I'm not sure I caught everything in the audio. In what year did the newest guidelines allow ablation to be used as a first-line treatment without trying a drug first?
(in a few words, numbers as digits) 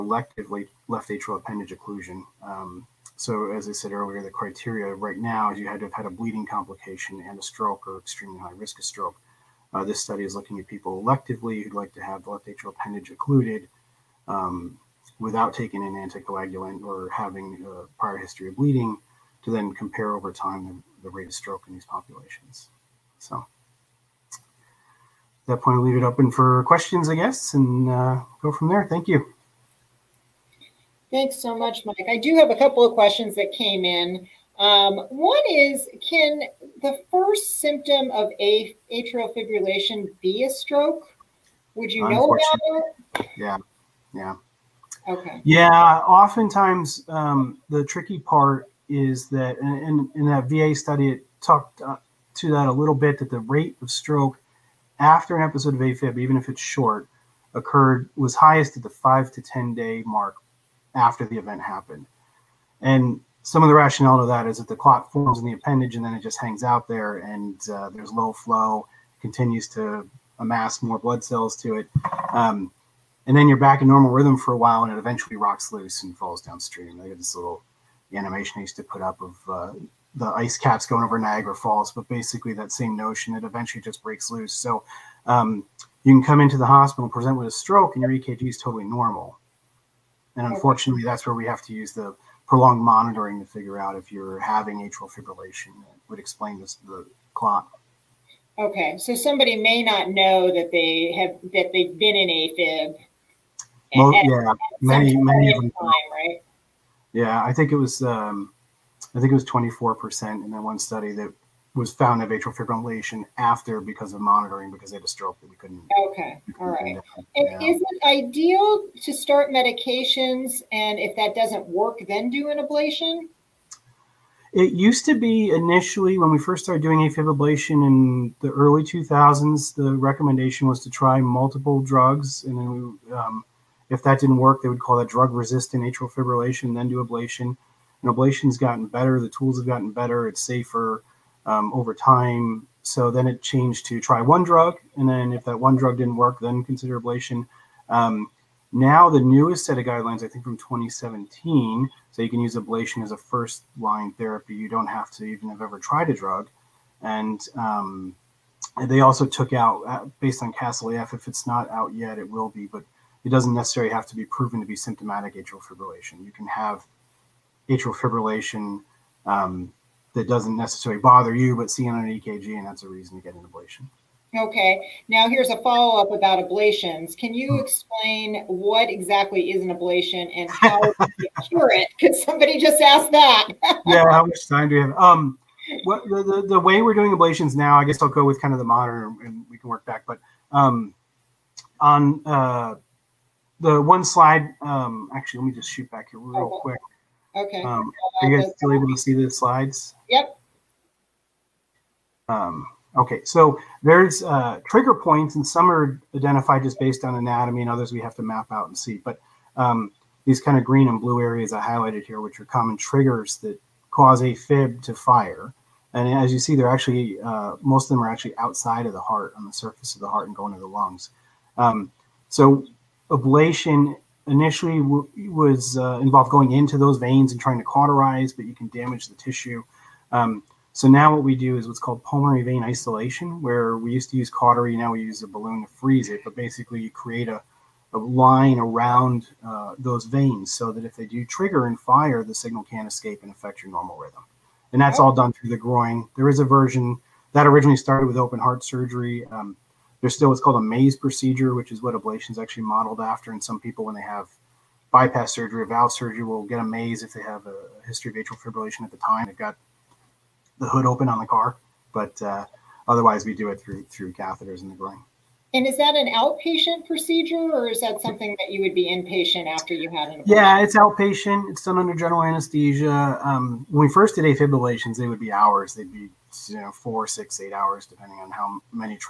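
2017.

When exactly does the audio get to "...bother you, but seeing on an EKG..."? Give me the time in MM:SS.
02:50.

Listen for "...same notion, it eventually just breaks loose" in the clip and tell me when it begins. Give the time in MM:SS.
01:22.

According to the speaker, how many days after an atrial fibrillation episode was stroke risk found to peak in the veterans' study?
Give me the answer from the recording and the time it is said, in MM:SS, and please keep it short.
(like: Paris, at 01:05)
5 to 10 days, at 00:58.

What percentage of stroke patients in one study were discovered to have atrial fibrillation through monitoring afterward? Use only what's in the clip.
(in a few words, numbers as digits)
24 percent.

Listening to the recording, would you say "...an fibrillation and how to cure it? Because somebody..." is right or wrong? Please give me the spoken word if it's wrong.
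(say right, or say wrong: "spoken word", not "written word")
wrong: "ablation", not "fibrillation".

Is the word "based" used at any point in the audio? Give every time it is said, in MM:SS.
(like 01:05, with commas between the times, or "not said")
02:40, 03:26.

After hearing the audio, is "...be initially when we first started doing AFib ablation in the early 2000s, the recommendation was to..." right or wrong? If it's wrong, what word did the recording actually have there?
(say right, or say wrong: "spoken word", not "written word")
right.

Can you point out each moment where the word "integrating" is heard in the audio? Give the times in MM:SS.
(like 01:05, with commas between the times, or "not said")
not said.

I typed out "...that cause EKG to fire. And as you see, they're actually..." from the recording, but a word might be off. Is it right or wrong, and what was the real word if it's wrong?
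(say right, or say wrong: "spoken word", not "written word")
wrong: "AFib", not "EKG".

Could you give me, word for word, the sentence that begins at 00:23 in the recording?
So at that point, I'll leave it open for questions, I guess, and uh, go from there.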